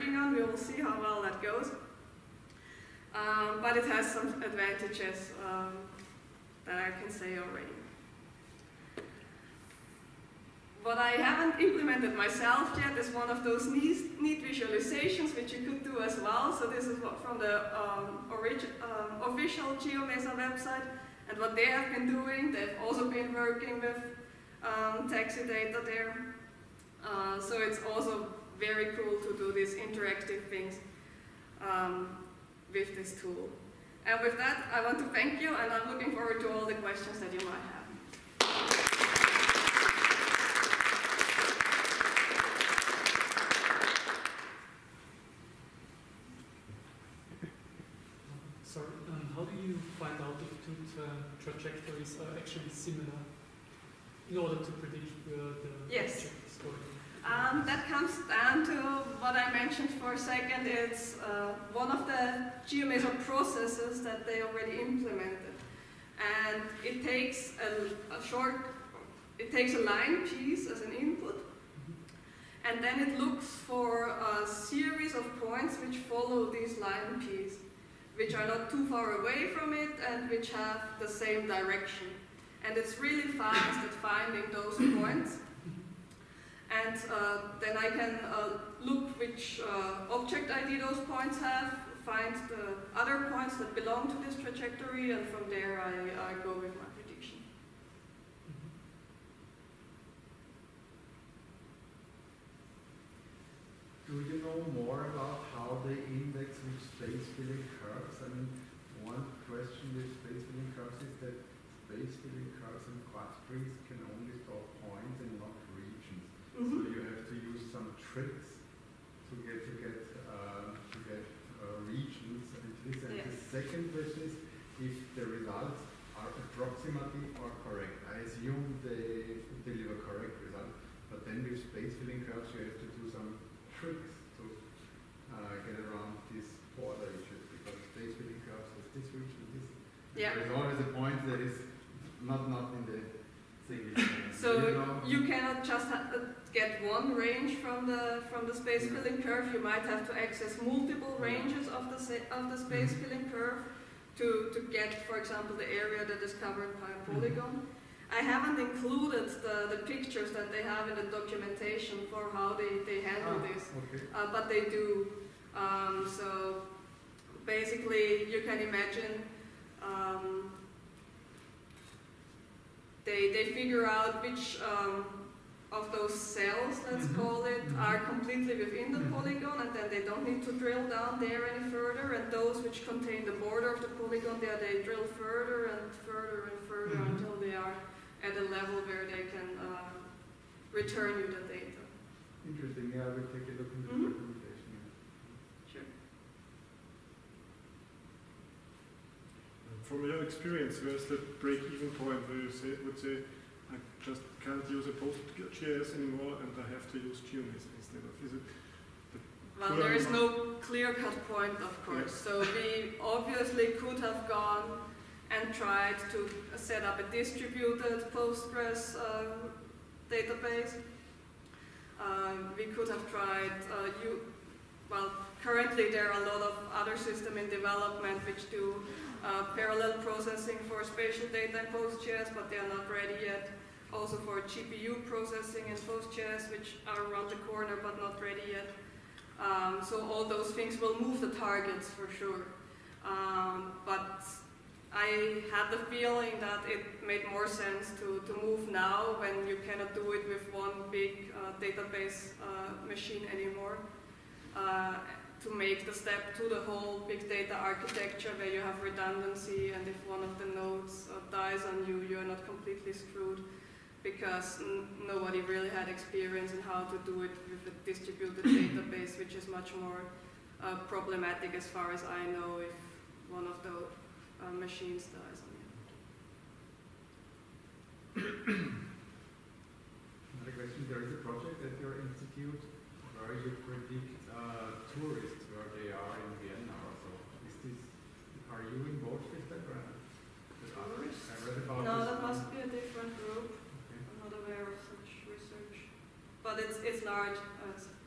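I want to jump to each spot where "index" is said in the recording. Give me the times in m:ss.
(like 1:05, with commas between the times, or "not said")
1:46.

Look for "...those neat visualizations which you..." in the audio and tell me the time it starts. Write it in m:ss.
0:13.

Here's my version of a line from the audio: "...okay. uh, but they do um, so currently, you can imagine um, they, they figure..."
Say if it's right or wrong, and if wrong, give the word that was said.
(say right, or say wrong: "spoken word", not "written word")
wrong: "basically", not "currently".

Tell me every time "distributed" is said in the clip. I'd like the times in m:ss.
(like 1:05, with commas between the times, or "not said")
3:37, 4:27.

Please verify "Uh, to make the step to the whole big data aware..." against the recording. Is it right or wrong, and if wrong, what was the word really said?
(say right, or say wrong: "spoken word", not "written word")
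wrong: "architecture", not "aware".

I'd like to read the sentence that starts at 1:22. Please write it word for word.
And it's really fast at finding those points.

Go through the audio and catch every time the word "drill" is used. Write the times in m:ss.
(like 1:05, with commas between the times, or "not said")
3:00, 3:04.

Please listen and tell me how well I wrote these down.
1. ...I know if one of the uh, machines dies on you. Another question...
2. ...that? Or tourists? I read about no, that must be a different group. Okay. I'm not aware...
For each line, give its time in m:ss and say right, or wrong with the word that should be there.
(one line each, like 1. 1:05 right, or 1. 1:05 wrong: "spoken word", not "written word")
1. 4:32 right
2. 4:49 right.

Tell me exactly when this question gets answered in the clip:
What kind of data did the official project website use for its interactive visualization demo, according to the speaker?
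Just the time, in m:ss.
0:25.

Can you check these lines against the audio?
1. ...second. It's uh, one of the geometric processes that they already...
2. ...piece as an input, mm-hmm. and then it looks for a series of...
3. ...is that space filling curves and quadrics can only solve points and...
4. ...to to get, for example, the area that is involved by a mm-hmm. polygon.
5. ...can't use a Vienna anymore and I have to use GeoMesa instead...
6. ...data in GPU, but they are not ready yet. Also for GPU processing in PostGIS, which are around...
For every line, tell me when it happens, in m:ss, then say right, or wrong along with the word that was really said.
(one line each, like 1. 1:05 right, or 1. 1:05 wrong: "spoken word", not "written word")
1. 1:00 right
2. 1:10 right
3. 1:51 right
4. 2:34 wrong: "covered", not "involved"
5. 3:24 wrong: "PostGIS", not "Vienna"
6. 3:51 wrong: "PostGIS", not "GPU".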